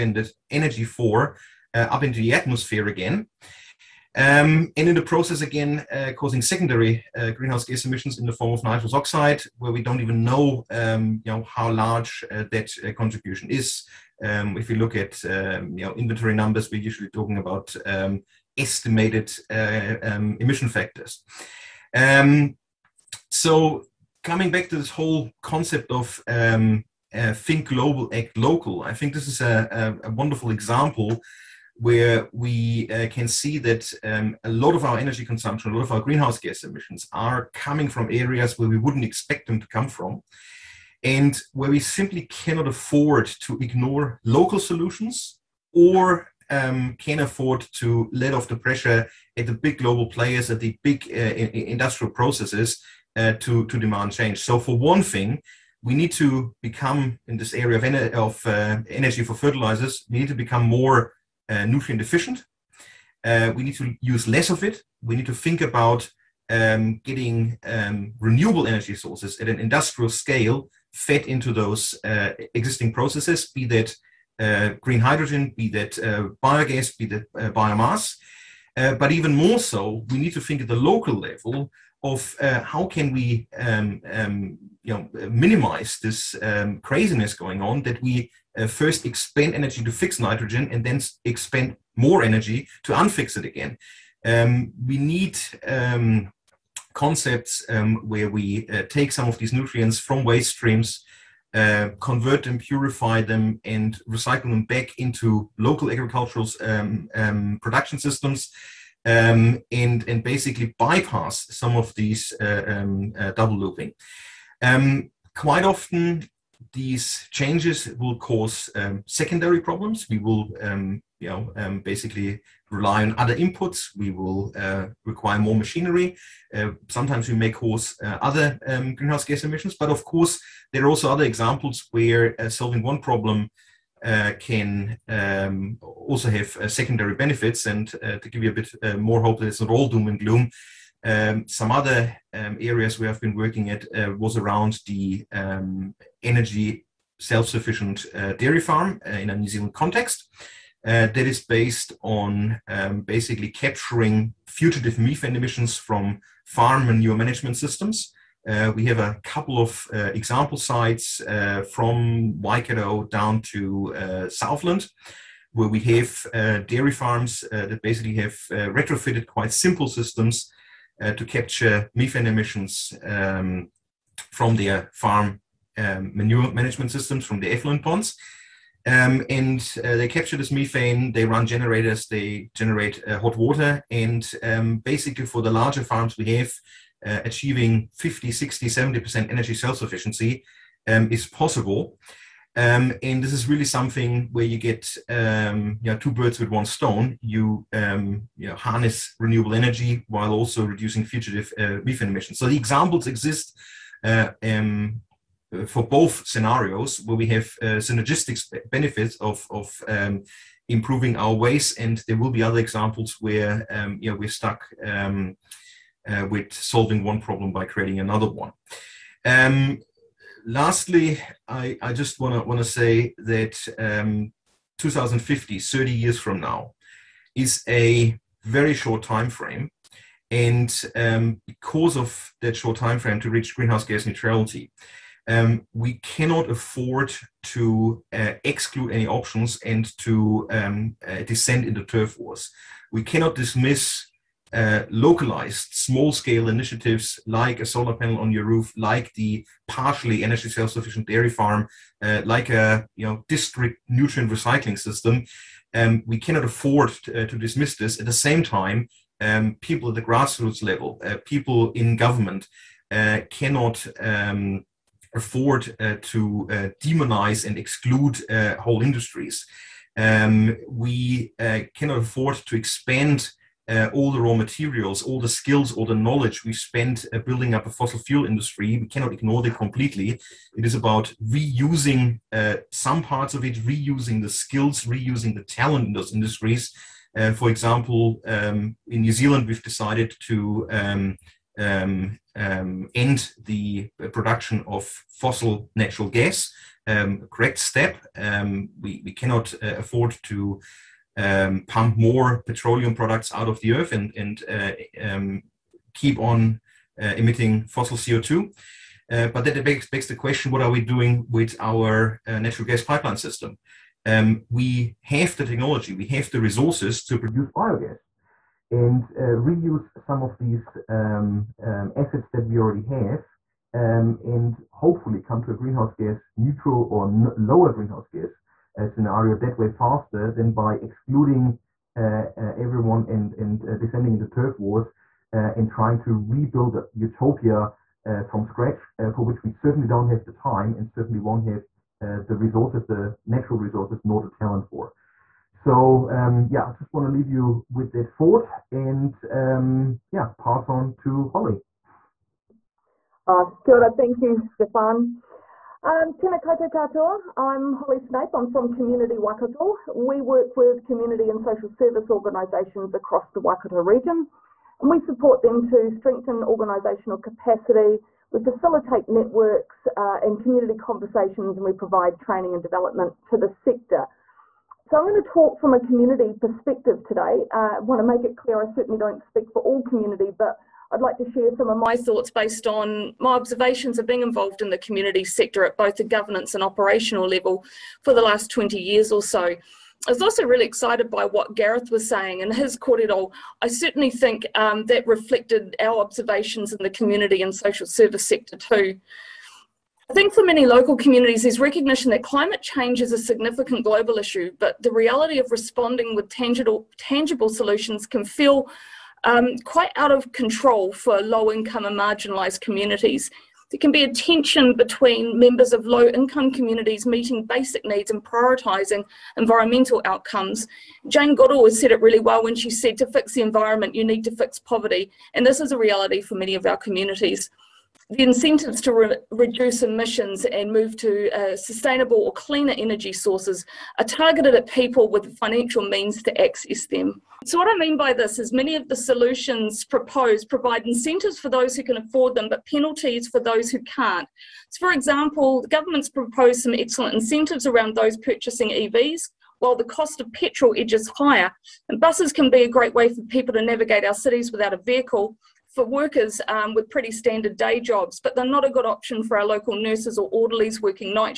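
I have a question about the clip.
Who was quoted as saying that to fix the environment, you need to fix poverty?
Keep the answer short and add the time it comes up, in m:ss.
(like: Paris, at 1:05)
Jane Goodall, at 7:01.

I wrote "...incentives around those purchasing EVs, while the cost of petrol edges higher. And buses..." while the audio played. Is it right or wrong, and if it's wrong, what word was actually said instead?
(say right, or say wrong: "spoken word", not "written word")
right.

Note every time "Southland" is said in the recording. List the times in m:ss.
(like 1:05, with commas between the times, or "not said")
2:44.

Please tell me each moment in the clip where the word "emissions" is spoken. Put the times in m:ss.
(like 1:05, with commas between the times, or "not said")
0:07, 0:20, 0:36, 2:09, 2:35, 2:52, 3:22, 7:09.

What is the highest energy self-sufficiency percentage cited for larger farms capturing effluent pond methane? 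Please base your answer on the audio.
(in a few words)
70%.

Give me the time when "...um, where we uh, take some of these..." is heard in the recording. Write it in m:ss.
1:37.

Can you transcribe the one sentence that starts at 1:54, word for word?
Um, quite often, these changes will cause um, secondary problems.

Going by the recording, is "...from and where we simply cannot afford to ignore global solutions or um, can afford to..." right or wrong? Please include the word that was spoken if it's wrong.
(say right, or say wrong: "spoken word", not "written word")
wrong: "local", not "global".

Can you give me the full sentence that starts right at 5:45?
So um, yeah, I just want to leave you with that thought and um, yeah, pass on to Holly.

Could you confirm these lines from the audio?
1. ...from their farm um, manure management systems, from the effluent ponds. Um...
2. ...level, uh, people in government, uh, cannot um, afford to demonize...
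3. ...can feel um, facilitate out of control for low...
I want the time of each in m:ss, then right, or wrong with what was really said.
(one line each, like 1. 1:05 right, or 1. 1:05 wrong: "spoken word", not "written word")
1. 2:54 right
2. 4:20 right
3. 6:48 wrong: "quite", not "facilitate".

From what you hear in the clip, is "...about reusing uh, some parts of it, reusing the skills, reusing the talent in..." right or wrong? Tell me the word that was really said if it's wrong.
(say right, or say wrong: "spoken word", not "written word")
right.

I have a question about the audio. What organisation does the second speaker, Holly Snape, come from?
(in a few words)
Community Waikato.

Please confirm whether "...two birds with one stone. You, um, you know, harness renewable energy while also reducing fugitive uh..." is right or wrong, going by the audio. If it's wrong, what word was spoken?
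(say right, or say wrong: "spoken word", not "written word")
right.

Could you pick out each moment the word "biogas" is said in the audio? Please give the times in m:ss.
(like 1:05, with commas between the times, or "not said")
1:16, 5:17.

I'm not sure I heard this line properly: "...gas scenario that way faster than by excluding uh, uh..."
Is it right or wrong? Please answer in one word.
right.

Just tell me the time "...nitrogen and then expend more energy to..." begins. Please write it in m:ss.
1:30.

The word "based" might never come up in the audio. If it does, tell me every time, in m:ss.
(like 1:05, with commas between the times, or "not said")
2:31, 6:22.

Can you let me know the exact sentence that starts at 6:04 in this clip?
And we support them to strengthen organisational capacity.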